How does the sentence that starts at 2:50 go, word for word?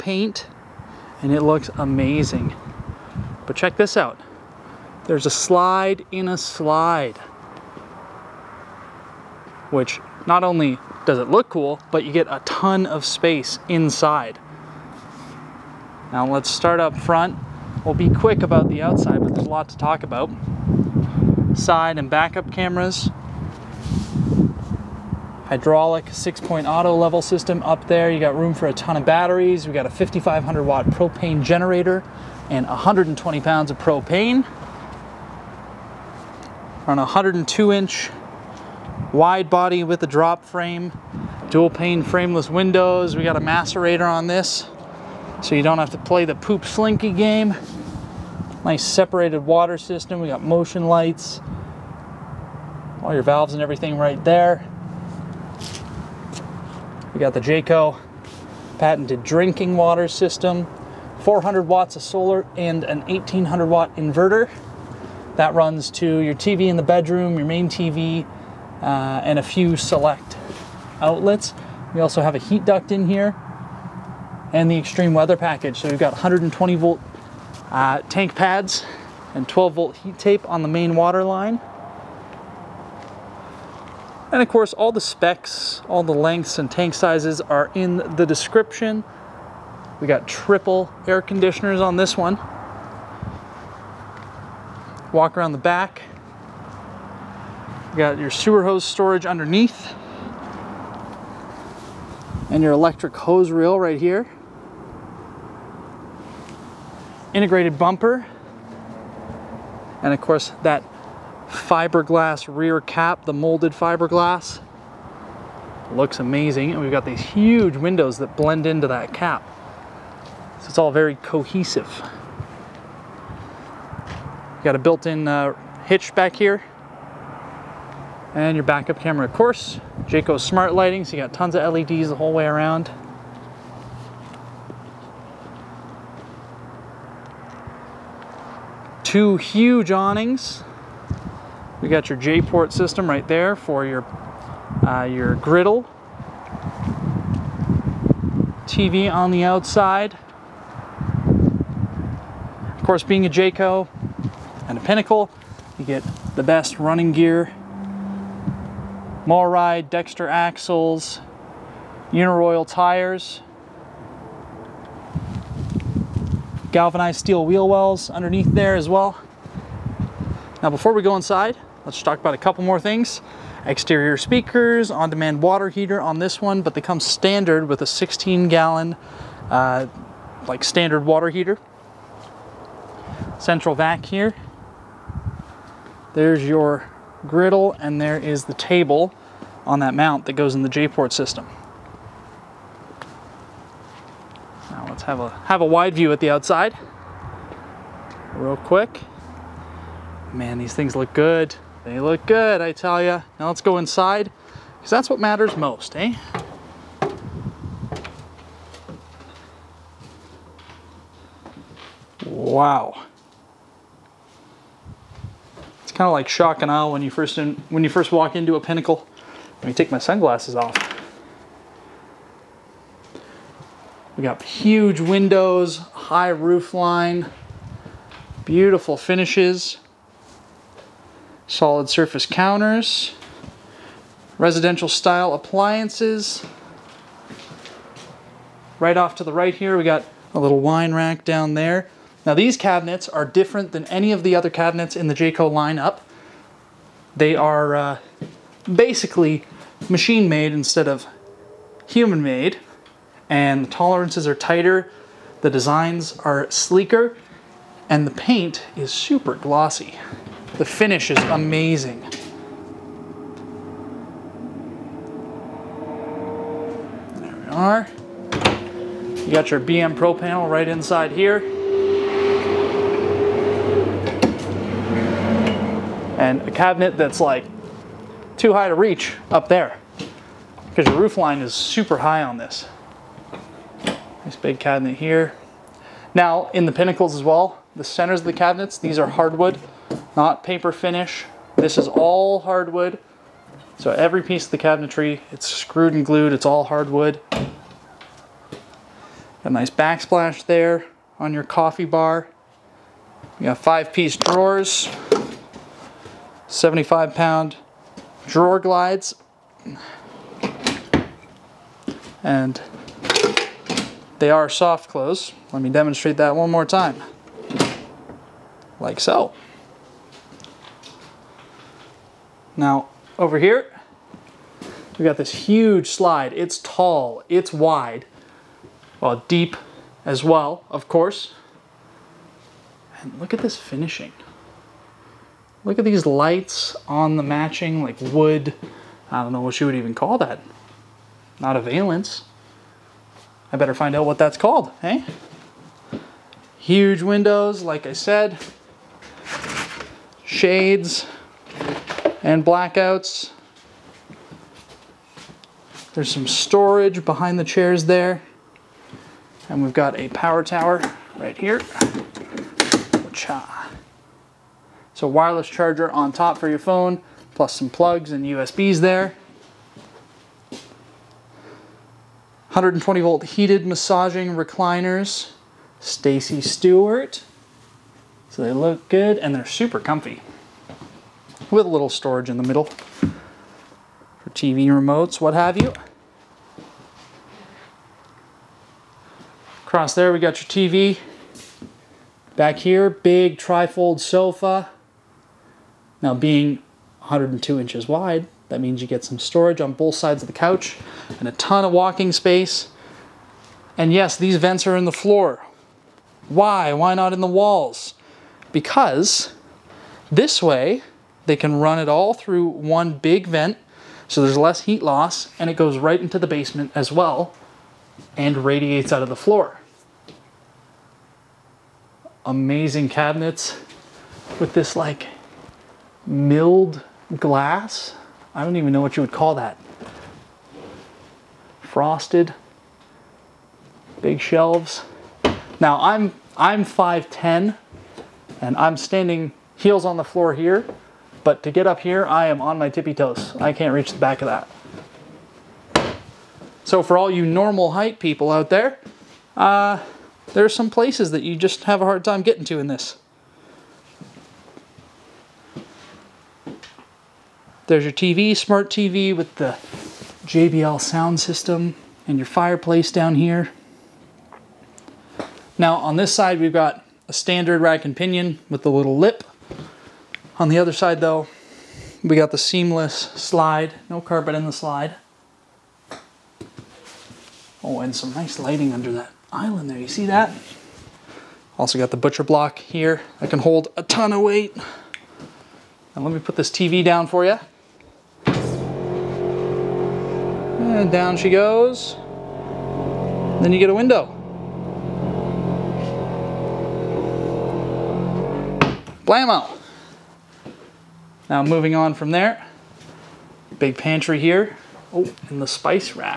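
Now before we go inside, let's talk about a couple more things.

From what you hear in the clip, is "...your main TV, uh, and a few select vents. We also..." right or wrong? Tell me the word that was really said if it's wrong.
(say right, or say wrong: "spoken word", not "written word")
wrong: "outlets", not "vents".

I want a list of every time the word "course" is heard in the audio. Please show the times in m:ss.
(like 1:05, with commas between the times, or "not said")
1:24, 1:50, 2:09, 2:32, 5:30.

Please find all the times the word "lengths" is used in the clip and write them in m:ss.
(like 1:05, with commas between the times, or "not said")
1:26.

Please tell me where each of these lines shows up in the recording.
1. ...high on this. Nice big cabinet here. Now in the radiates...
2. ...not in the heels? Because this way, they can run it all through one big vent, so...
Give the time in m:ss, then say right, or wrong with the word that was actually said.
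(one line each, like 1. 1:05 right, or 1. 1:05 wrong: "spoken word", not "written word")
1. 4:41 wrong: "pinnacles", not "radiates"
2. 6:46 wrong: "walls", not "heels".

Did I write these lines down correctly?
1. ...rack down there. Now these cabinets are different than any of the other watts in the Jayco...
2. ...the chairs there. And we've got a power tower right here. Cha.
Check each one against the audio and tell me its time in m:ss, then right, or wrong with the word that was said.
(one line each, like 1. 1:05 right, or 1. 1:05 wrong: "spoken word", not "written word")
1. 4:00 wrong: "cabinets", not "watts"
2. 5:57 right.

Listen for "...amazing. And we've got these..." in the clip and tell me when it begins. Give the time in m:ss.
1:56.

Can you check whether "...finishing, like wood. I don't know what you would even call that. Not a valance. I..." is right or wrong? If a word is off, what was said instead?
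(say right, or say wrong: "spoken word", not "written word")
wrong: "matching", not "finishing".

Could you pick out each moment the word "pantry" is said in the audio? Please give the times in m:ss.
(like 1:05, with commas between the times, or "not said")
8:23.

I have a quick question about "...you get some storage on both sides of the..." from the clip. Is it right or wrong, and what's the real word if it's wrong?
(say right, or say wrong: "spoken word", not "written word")
right.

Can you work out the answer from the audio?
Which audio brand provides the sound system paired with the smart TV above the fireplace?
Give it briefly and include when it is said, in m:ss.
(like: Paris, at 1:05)
JBL, at 7:40.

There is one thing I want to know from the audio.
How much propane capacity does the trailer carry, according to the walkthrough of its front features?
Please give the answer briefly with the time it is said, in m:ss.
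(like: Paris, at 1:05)
120 pounds, at 0:32.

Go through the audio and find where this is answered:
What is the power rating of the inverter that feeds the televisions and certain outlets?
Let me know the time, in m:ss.
1:03.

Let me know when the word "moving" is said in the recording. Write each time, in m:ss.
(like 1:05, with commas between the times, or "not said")
8:21.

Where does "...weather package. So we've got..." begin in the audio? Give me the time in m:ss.
1:15.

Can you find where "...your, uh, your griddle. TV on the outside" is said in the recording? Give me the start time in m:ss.
2:23.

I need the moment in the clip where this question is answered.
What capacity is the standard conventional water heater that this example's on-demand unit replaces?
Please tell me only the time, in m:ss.
2:57.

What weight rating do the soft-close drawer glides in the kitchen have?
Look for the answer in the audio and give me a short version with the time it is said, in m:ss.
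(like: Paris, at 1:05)
75 pounds, at 5:06.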